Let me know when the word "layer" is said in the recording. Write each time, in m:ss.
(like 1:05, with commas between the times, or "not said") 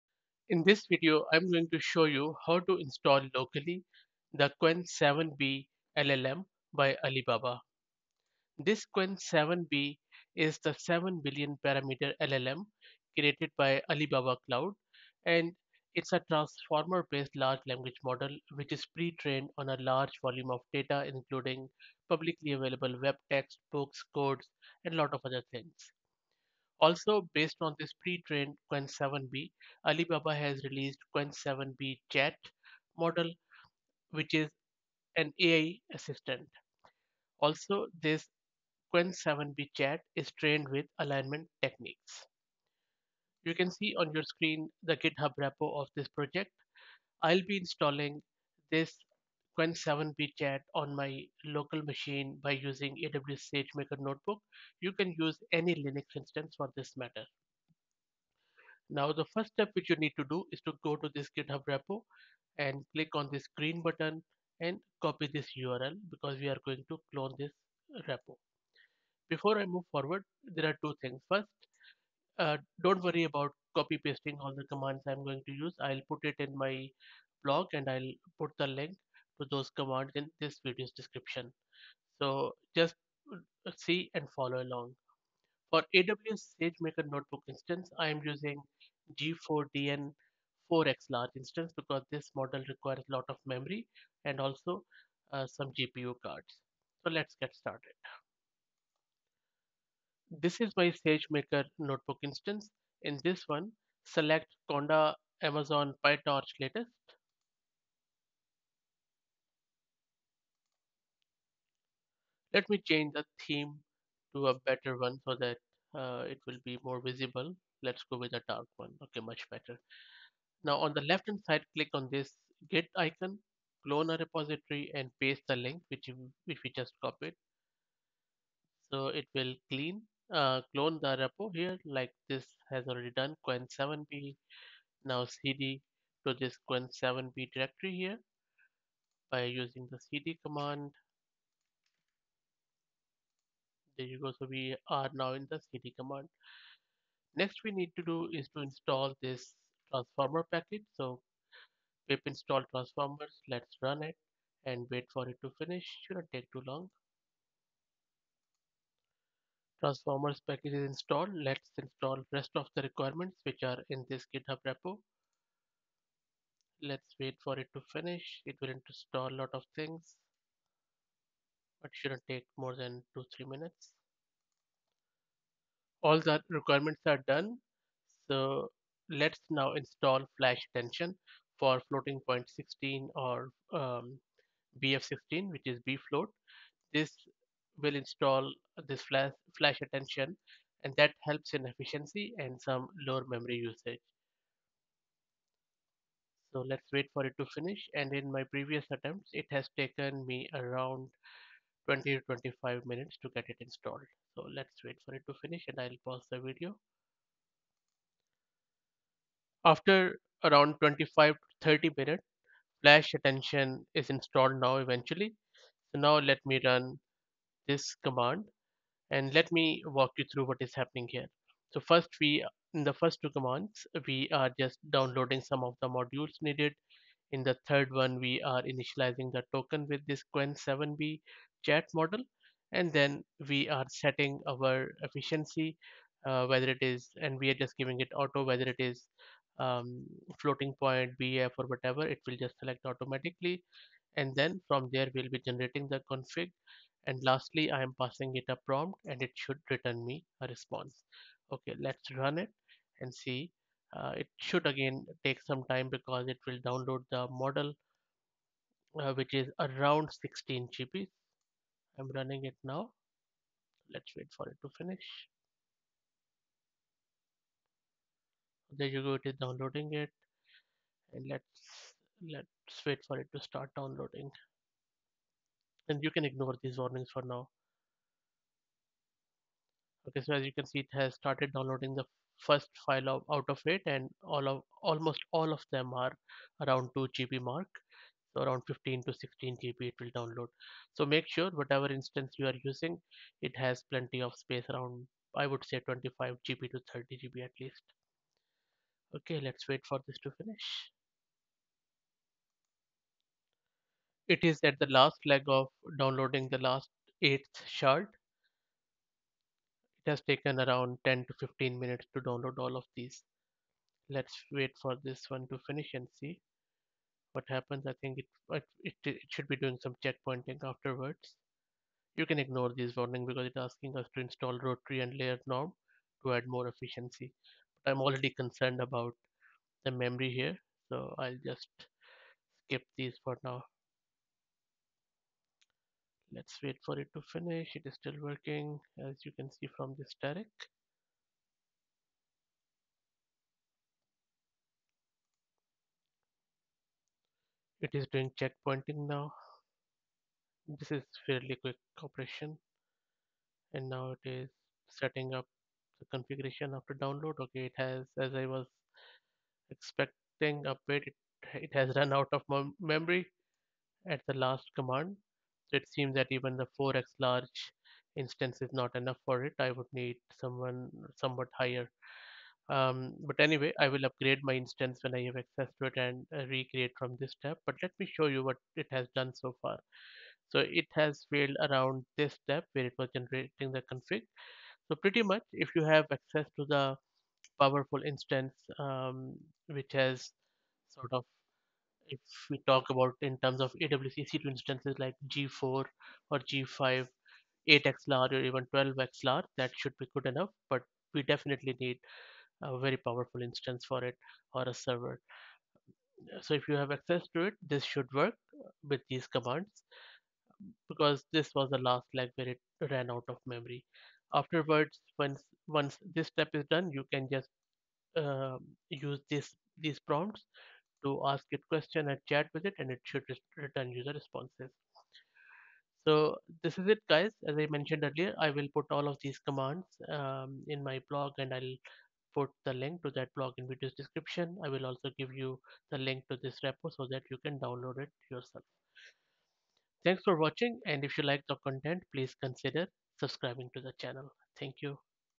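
5:25.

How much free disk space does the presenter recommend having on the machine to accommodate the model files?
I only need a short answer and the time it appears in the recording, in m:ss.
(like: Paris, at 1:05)
25 to 30 GB, at 4:55.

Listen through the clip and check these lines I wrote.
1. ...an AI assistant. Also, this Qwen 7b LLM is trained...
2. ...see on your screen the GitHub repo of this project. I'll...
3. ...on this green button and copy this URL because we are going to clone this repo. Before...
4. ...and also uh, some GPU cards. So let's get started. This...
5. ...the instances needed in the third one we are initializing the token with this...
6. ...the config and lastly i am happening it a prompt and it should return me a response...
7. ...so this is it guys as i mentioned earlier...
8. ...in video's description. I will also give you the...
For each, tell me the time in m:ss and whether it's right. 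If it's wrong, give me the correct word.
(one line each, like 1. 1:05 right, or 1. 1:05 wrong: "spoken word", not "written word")
1. 0:35 wrong: "Chat", not "LLM"
2. 0:43 right
3. 1:03 right
4. 1:34 right
5. 3:45 wrong: "modules", not "instances"
6. 4:05 wrong: "passing", not "happening"
7. 7:06 right
8. 7:13 right.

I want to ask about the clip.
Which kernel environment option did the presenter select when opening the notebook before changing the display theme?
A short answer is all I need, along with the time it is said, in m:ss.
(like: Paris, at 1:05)
Conda Amazon PyTorch latest, at 1:44.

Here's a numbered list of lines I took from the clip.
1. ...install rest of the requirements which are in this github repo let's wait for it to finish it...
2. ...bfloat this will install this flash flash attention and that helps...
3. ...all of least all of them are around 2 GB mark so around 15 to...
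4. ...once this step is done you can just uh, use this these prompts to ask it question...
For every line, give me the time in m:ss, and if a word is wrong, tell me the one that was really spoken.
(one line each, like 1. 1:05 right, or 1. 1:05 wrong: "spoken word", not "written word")
1. 2:41 right
2. 3:05 right
3. 4:44 wrong: "almost", not "least"
4. 6:55 right.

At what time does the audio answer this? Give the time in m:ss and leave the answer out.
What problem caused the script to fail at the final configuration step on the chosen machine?
6:01.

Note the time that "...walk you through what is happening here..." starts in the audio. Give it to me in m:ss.
3:39.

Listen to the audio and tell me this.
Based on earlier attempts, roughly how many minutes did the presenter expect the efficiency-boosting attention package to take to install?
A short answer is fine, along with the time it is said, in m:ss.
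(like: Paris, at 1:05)
20 to 25 minutes, at 3:21.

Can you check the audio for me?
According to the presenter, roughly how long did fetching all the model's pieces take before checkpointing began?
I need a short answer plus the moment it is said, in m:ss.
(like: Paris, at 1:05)
10 to 15 minutes, at 5:11.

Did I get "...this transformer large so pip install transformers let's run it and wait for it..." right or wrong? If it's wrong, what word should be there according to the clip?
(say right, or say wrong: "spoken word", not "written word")
wrong: "package", not "large".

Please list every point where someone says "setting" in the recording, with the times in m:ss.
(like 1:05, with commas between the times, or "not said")
3:53, 5:54.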